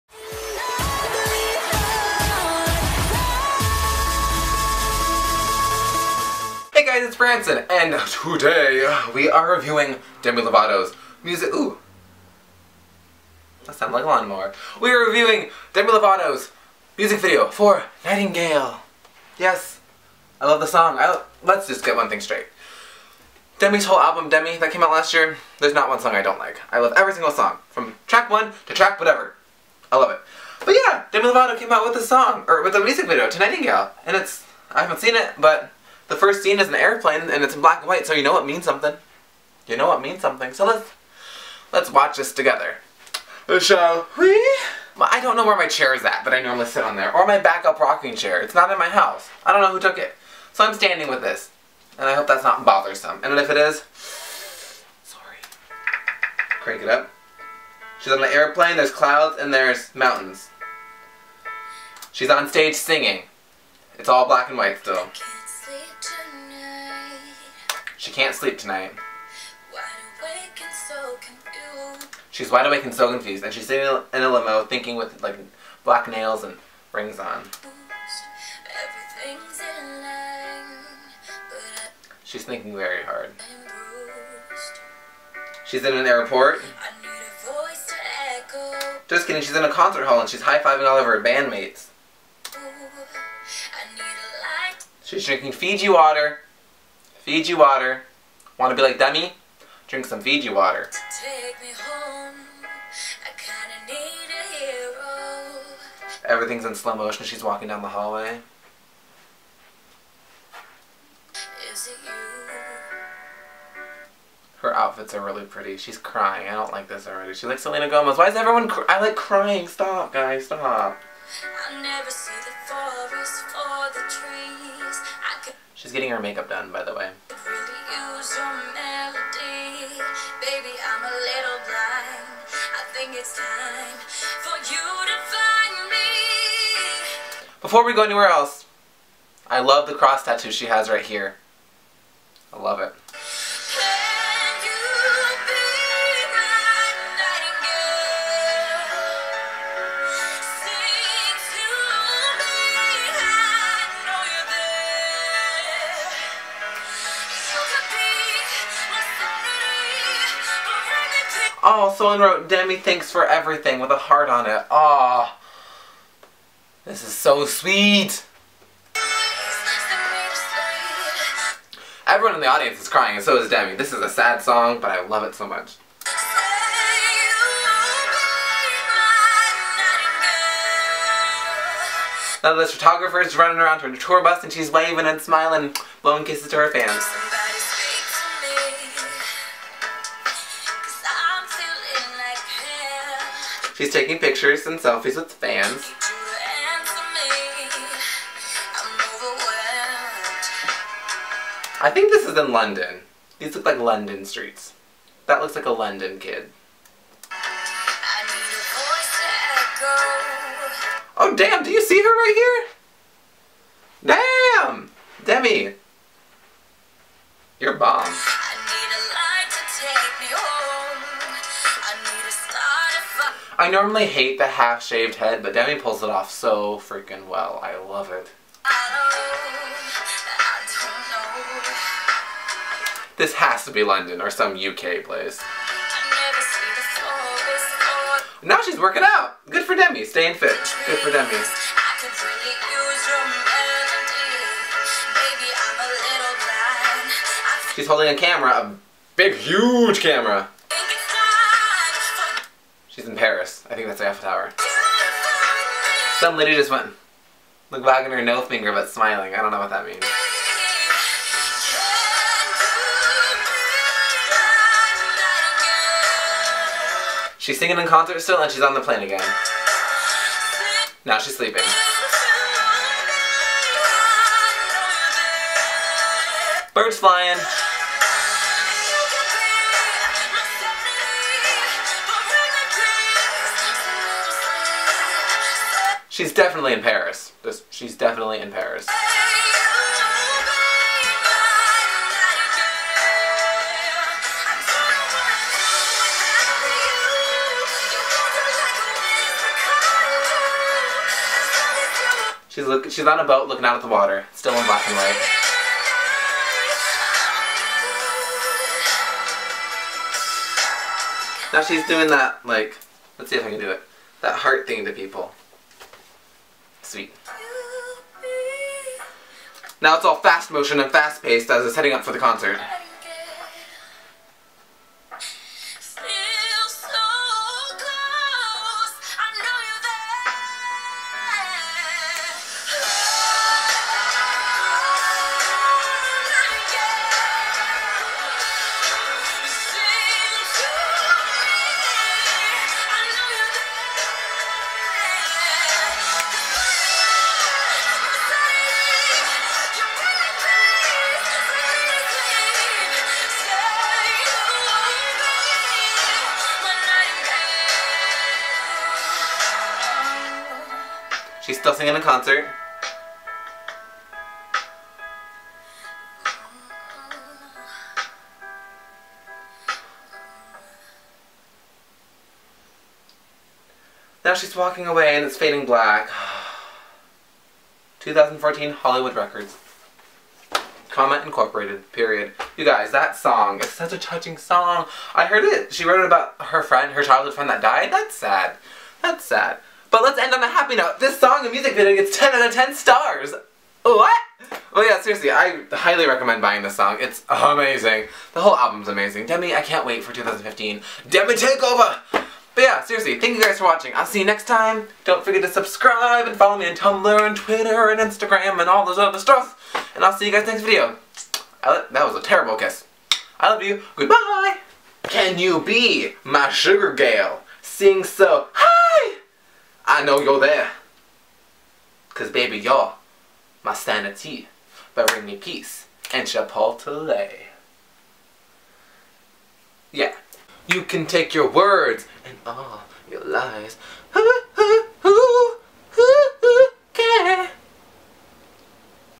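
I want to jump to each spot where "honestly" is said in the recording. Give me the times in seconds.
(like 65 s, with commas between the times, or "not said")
not said.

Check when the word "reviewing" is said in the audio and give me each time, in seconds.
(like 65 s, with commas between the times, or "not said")
9 s, 15 s.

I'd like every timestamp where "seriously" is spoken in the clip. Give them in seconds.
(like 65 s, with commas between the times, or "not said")
395 s, 402 s.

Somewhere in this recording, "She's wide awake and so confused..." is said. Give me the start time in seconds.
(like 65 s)
72 s.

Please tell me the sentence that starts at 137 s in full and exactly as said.
Before we go anywhere else, I love the cross tattoo she has right here.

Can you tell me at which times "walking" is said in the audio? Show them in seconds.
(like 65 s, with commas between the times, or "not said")
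107 s, 374 s.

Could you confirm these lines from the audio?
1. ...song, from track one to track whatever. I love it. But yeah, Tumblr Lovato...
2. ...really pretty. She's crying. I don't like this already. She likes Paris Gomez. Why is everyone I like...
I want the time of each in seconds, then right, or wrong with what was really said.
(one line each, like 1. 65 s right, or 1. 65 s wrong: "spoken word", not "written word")
1. 27 s wrong: "Demi", not "Tumblr"
2. 115 s wrong: "Selena", not "Paris".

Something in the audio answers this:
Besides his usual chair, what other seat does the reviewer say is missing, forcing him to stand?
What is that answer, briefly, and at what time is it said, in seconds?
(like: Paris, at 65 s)
rocking chair, at 47 s.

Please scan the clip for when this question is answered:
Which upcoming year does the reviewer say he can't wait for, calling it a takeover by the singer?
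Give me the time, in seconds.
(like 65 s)
400 s.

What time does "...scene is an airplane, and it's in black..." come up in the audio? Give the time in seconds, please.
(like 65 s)
36 s.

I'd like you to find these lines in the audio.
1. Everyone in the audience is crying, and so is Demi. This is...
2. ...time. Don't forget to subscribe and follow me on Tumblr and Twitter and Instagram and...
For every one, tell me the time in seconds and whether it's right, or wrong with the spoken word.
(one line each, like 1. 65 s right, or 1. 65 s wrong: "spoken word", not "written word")
1. 172 s right
2. 404 s right.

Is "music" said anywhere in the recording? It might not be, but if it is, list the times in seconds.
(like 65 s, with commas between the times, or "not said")
11 s, 16 s, 32 s, 391 s.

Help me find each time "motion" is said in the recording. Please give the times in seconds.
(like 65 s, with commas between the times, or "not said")
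106 s, 320 s.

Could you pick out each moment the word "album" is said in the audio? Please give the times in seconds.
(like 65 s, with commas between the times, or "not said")
23 s, 398 s.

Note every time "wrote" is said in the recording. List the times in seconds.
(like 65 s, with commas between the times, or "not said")
162 s, 385 s.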